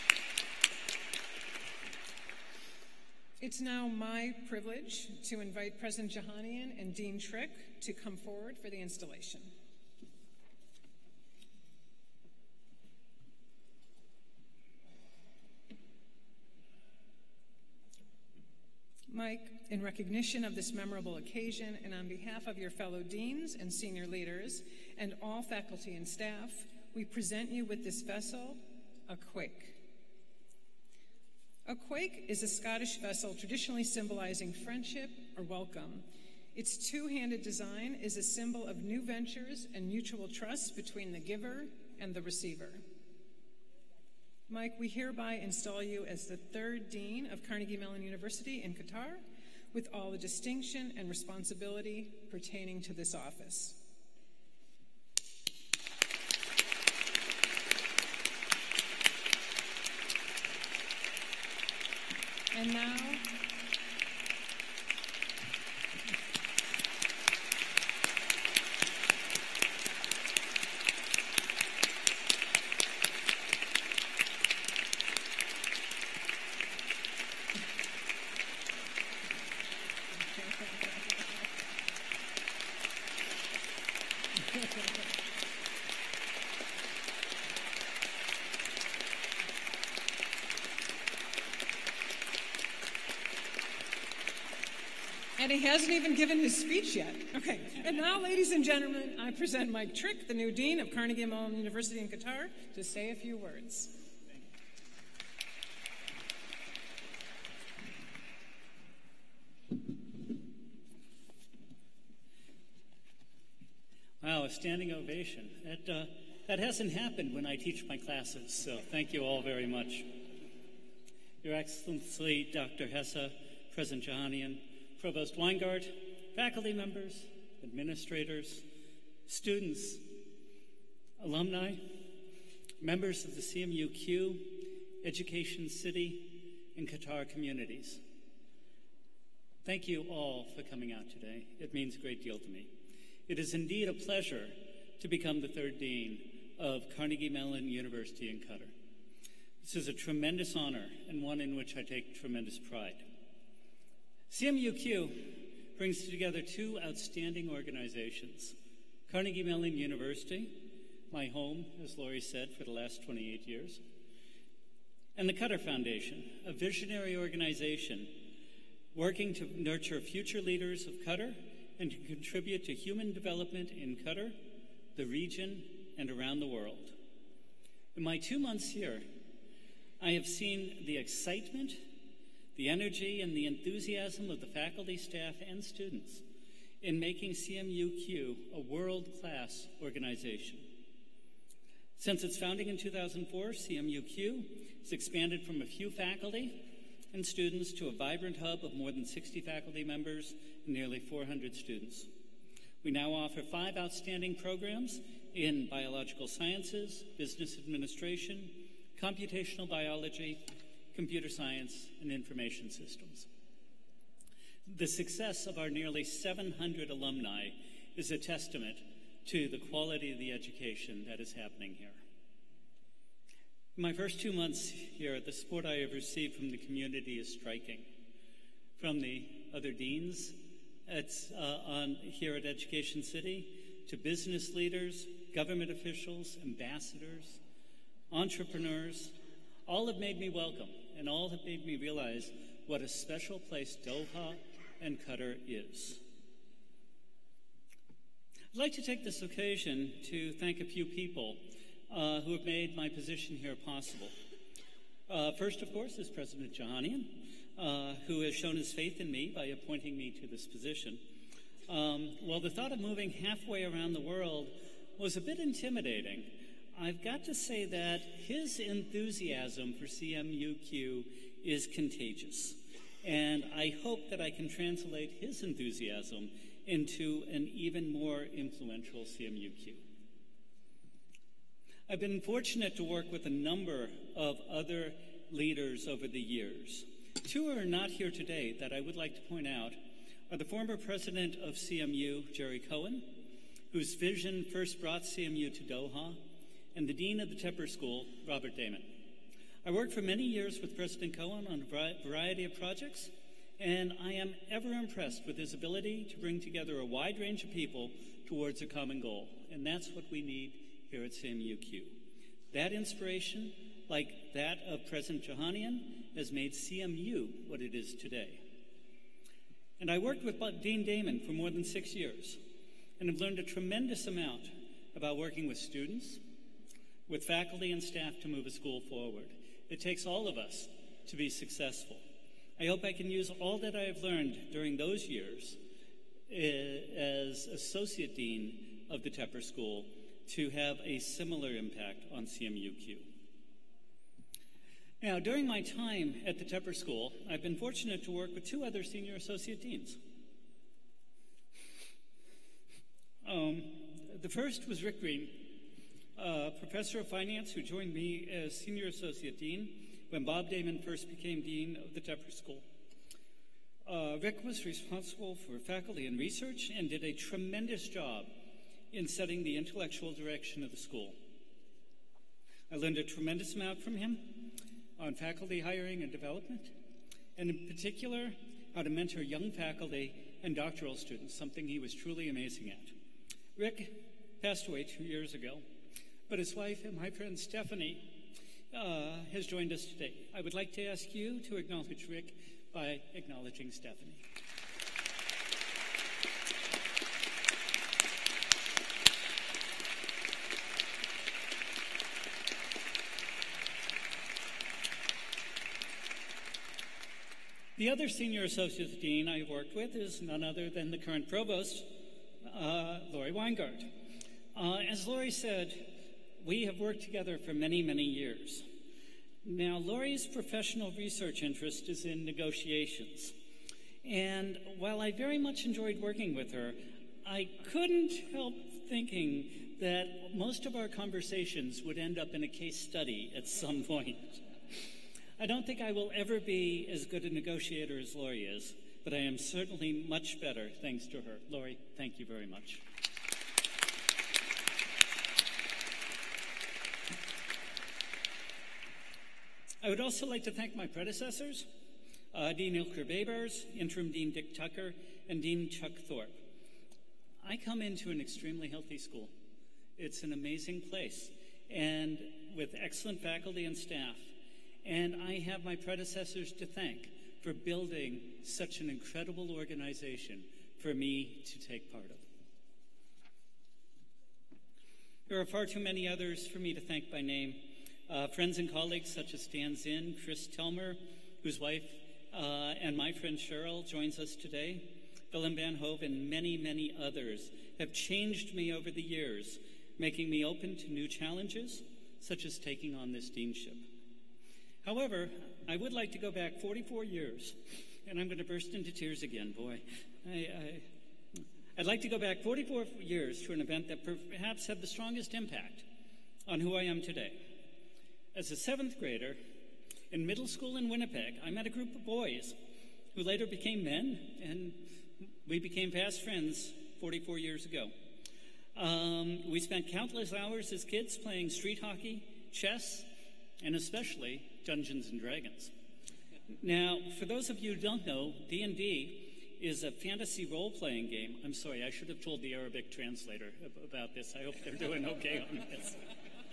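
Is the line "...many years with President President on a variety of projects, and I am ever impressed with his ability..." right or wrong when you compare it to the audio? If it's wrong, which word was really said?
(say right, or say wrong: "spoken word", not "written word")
wrong: "Cohon", not "President".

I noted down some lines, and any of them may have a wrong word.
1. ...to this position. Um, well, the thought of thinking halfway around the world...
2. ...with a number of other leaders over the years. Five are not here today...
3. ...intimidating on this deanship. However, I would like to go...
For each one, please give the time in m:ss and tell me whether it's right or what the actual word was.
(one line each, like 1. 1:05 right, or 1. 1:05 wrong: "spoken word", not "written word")
1. 4:20 wrong: "moving", not "thinking"
2. 4:43 wrong: "Two", not "Five"
3. 8:12 wrong: "taking", not "intimidating".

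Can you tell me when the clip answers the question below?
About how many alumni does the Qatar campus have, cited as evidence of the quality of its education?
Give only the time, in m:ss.
3:35.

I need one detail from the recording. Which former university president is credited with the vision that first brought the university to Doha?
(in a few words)
Jerry Cohon.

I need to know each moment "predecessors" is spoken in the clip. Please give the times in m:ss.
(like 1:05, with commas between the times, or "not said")
7:30, 7:45.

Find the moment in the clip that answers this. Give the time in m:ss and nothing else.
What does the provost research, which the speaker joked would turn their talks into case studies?
7:02.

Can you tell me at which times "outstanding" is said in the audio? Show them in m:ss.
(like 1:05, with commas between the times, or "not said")
2:36, 3:23.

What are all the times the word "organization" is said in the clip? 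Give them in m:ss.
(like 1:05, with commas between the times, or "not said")
2:37, 2:47, 3:09, 7:49.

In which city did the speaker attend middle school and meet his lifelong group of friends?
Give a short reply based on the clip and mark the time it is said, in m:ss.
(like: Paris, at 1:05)
Winnipeg, at 8:30.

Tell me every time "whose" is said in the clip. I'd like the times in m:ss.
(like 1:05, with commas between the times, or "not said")
4:53, 8:01.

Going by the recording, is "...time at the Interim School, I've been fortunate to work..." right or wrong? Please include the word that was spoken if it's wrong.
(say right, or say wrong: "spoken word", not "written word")
wrong: "Tepper", not "Interim".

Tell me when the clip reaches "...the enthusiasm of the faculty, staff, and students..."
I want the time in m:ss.
3:03.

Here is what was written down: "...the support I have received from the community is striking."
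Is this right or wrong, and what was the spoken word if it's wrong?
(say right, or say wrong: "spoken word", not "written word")
right.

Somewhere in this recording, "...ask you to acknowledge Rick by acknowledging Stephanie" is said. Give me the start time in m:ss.
6:30.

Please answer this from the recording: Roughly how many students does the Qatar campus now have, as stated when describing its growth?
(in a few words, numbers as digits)
nearly 400.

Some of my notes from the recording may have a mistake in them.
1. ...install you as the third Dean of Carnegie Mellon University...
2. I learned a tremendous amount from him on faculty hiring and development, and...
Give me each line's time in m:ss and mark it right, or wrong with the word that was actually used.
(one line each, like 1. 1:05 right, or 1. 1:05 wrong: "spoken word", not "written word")
1. 0:45 right
2. 6:12 right.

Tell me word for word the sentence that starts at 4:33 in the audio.
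And I hope that I can translate his enthusiasm into an even more influential CMUQ.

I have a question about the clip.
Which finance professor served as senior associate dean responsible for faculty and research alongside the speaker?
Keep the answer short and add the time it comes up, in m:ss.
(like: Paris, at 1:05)
Rick Green, at 5:54.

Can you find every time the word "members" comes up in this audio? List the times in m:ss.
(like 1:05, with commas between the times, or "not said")
2:06, 2:12, 3:19.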